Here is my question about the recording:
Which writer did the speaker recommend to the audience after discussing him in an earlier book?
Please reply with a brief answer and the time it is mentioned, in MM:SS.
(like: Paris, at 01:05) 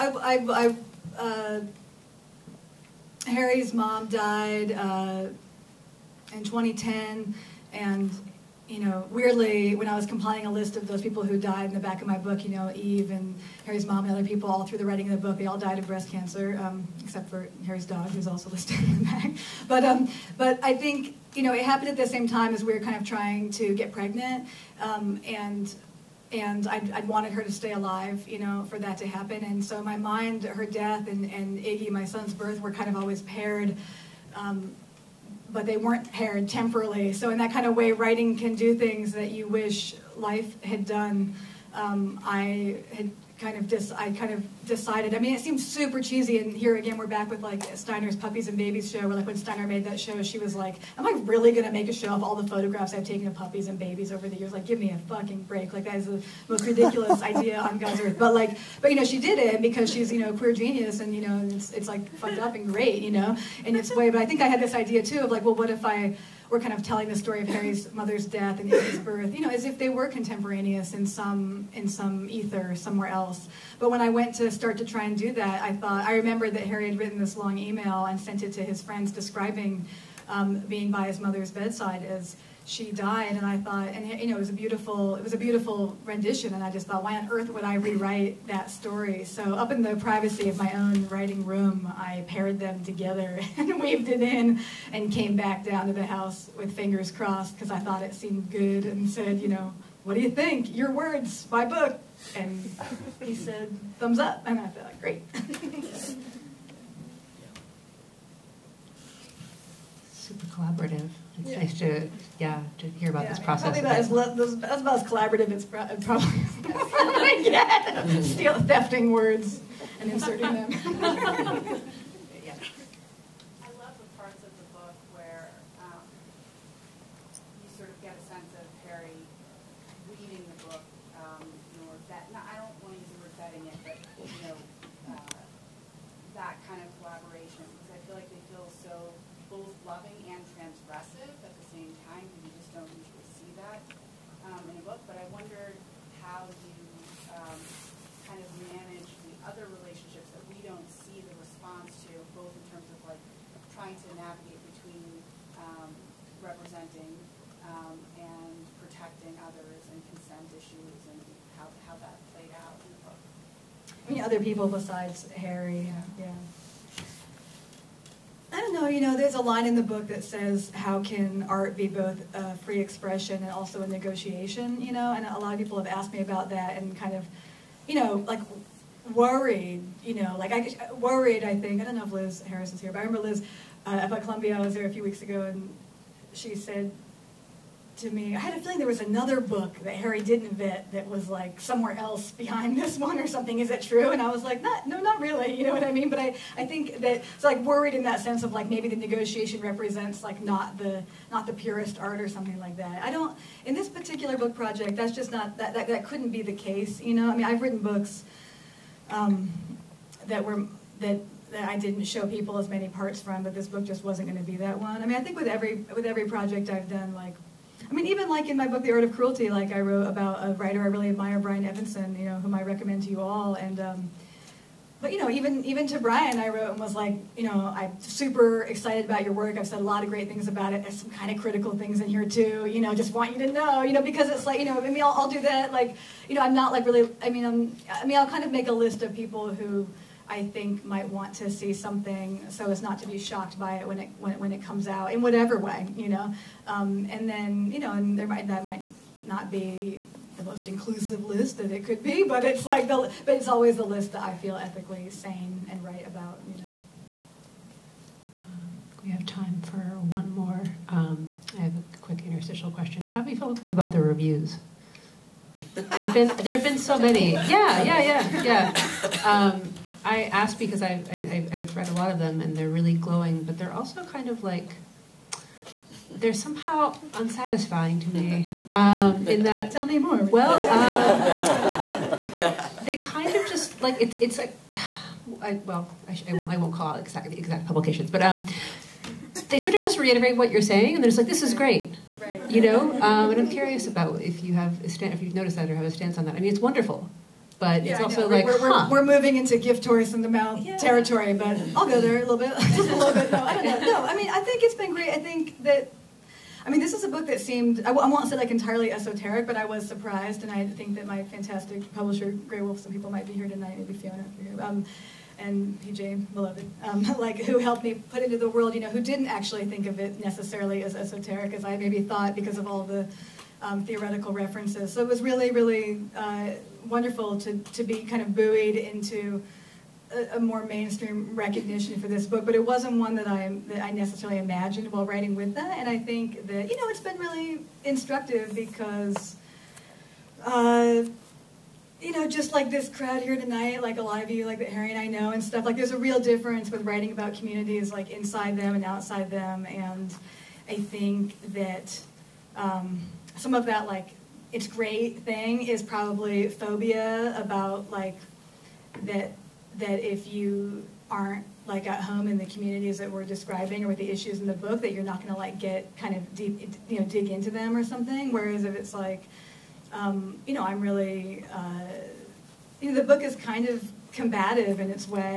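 Brian Evenson, at 03:41.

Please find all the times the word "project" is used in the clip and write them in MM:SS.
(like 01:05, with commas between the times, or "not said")
03:24, 03:36.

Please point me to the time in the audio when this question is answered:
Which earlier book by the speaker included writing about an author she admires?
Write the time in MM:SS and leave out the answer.
03:38.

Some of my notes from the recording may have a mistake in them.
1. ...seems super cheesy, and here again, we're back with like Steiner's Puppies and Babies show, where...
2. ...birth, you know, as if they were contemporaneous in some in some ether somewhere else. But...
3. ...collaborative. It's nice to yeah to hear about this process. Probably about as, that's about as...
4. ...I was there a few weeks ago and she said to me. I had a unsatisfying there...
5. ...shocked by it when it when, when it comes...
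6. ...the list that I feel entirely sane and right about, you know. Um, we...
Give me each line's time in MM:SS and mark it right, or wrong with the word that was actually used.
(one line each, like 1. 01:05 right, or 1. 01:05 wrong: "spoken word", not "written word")
1. 00:45 right
2. 01:08 right
3. 01:50 right
4. 03:04 wrong: "feeling", not "unsatisfying"
5. 04:03 right
6. 04:13 wrong: "ethically", not "entirely".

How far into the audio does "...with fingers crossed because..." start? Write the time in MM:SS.
01:36.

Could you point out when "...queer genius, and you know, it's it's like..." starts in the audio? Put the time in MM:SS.
01:00.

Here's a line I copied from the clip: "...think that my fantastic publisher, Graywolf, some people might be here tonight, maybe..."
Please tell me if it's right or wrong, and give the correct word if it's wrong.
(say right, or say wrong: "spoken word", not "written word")
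right.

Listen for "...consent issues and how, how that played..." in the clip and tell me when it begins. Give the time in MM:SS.
02:40.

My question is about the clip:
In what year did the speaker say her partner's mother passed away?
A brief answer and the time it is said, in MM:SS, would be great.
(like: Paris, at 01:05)
2010, at 00:06.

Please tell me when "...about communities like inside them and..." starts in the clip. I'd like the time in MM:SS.
05:47.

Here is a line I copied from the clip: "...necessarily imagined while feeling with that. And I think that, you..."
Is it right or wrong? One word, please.
wrong.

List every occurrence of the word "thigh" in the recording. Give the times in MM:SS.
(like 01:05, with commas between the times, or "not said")
not said.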